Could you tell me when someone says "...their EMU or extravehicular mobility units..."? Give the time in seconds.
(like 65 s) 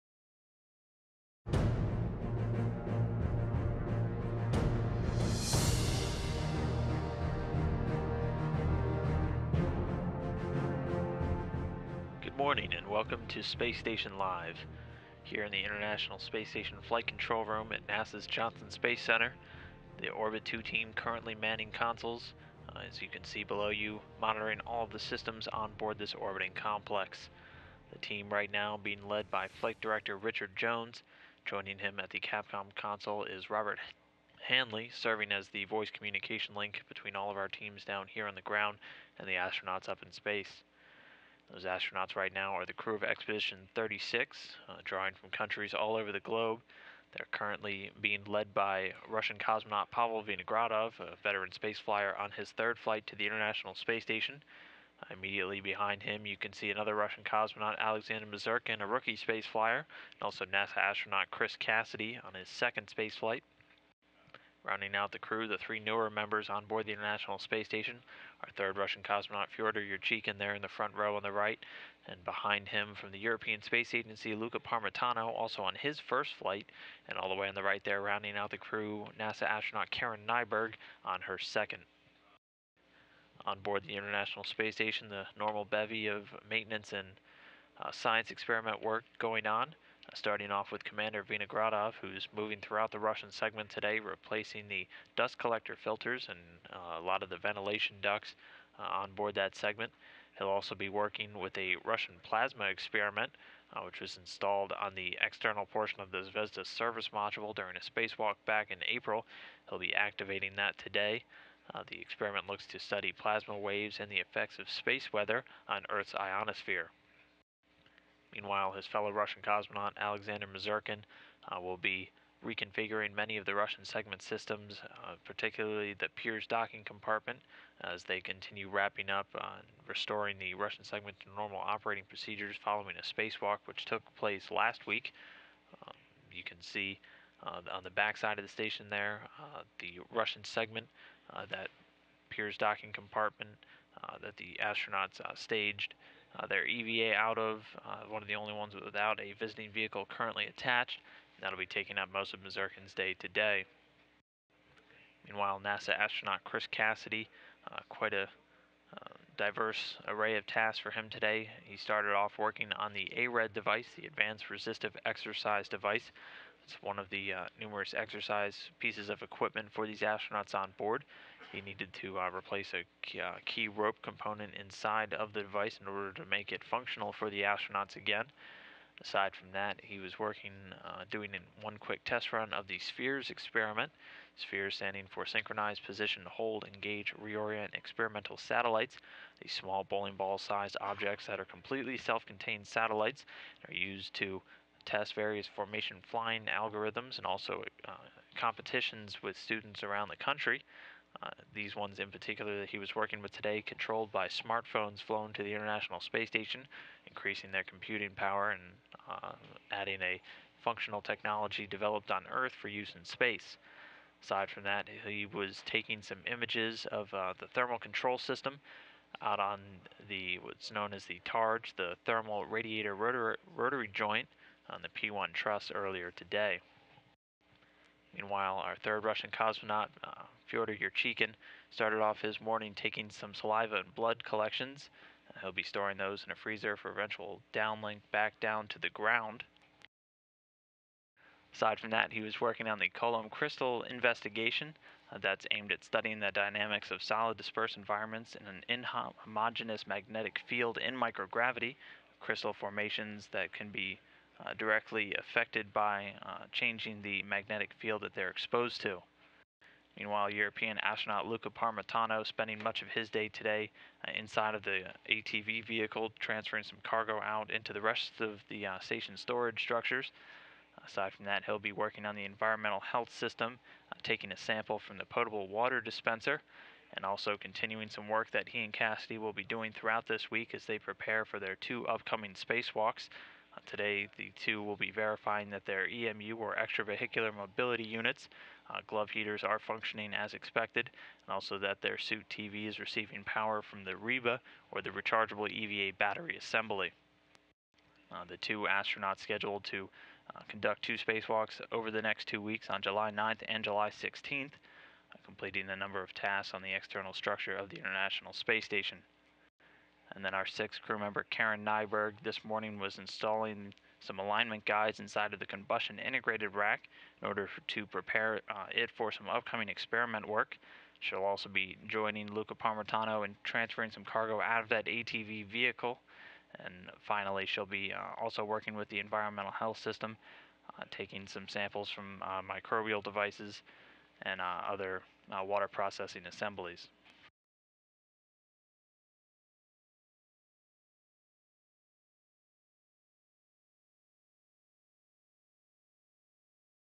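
285 s.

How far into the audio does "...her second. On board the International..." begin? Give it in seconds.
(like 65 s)
81 s.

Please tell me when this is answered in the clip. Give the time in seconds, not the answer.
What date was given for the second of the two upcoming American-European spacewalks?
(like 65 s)
303 s.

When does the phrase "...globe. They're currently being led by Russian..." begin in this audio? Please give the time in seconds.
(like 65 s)
46 s.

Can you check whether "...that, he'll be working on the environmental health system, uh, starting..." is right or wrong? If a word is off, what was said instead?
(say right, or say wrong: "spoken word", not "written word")
wrong: "taking", not "starting".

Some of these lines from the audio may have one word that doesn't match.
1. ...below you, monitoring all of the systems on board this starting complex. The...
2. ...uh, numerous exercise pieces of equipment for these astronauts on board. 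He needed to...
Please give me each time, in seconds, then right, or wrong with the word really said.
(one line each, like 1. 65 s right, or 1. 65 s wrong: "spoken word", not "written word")
1. 23 s wrong: "orbiting", not "starting"
2. 167 s right.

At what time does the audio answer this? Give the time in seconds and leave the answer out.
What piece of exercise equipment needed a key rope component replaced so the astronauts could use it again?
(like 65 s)
164 s.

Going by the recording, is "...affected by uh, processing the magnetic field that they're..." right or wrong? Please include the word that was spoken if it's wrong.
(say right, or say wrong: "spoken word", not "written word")
wrong: "changing", not "processing".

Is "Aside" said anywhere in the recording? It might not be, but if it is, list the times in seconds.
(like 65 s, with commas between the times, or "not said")
179 s, 214 s, 241 s, 270 s.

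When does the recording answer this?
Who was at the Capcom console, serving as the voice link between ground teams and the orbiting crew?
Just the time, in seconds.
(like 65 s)
33 s.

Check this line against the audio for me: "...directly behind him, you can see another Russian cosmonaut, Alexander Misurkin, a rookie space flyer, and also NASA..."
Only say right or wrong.
wrong.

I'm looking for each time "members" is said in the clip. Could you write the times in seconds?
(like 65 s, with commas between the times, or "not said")
66 s, 310 s.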